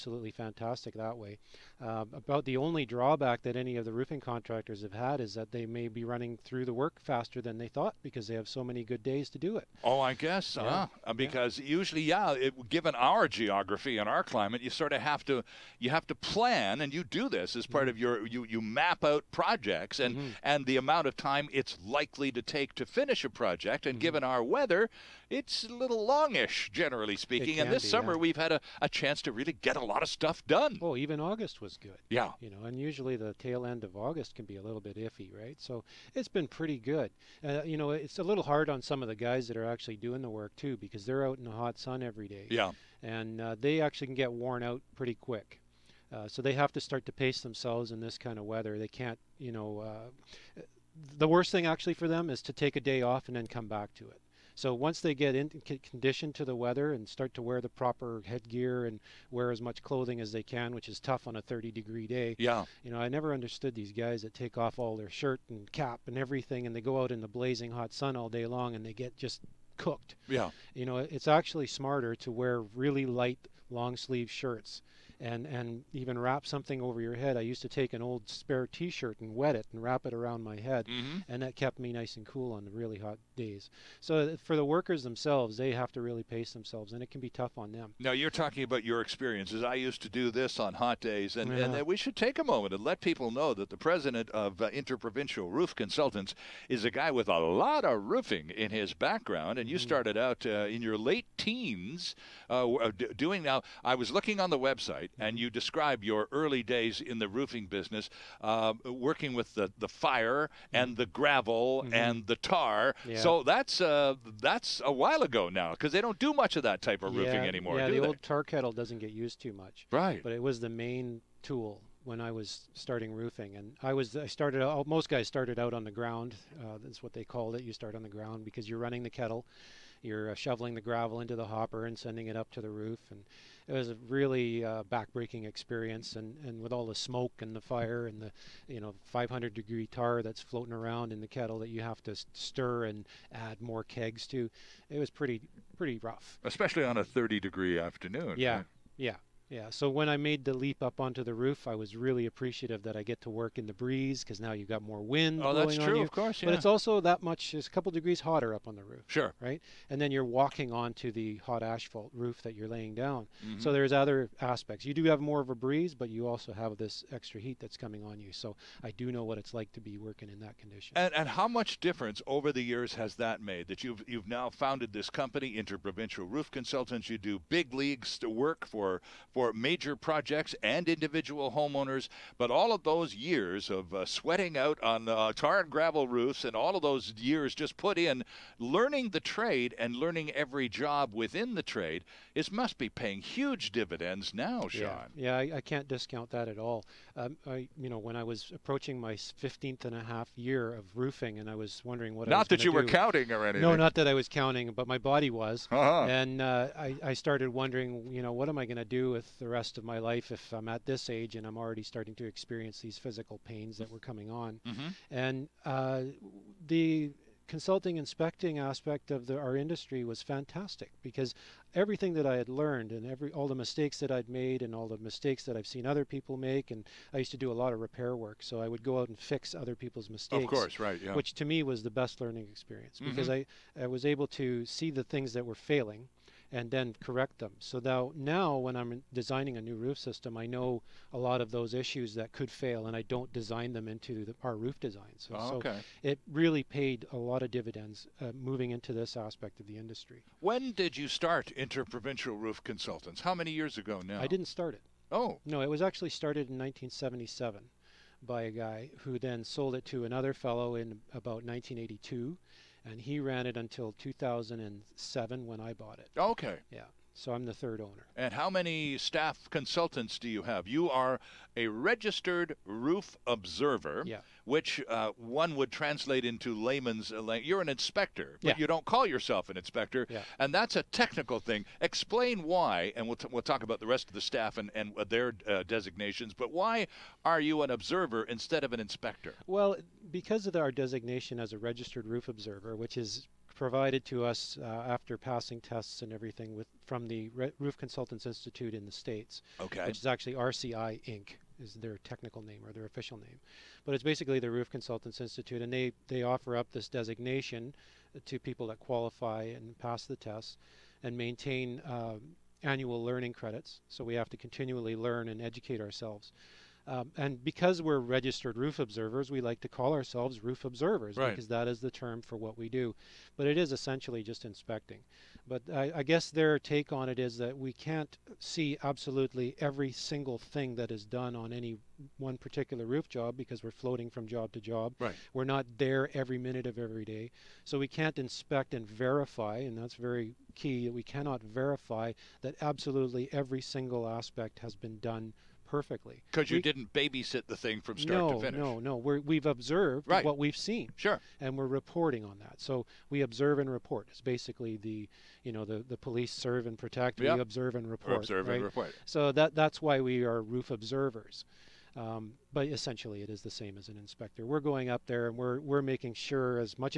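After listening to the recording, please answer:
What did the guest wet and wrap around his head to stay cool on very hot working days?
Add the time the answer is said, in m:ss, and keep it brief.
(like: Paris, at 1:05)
old spare T-shirt, at 1:17.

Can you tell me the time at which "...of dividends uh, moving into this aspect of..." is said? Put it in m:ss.
4:07.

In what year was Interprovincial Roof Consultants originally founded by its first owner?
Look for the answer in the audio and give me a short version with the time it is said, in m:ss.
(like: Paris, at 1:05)
1977, at 4:16.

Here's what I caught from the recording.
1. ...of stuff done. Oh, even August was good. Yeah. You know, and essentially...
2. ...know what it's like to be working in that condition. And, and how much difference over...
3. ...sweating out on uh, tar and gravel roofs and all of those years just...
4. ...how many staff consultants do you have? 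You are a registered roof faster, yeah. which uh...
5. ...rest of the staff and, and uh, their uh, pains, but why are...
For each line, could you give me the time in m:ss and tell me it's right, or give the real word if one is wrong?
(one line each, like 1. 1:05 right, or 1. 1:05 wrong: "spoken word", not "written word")
1. 0:30 wrong: "usually", not "essentially"
2. 2:49 right
3. 3:04 right
4. 4:28 wrong: "observer", not "faster"
5. 4:43 wrong: "designations", not "pains".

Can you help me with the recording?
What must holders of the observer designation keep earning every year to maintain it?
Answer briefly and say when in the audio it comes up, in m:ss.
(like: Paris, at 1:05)
annual learning credits, at 5:12.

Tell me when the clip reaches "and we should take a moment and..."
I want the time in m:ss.
1:31.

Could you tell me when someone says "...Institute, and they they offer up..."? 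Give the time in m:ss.
5:05.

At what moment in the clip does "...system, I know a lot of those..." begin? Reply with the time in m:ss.
3:59.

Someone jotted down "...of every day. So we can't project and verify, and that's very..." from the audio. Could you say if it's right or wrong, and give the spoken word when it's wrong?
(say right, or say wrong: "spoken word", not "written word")
wrong: "inspect", not "project".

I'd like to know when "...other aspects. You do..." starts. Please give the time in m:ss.
2:43.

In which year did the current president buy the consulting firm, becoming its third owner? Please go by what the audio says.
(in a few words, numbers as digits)
2007.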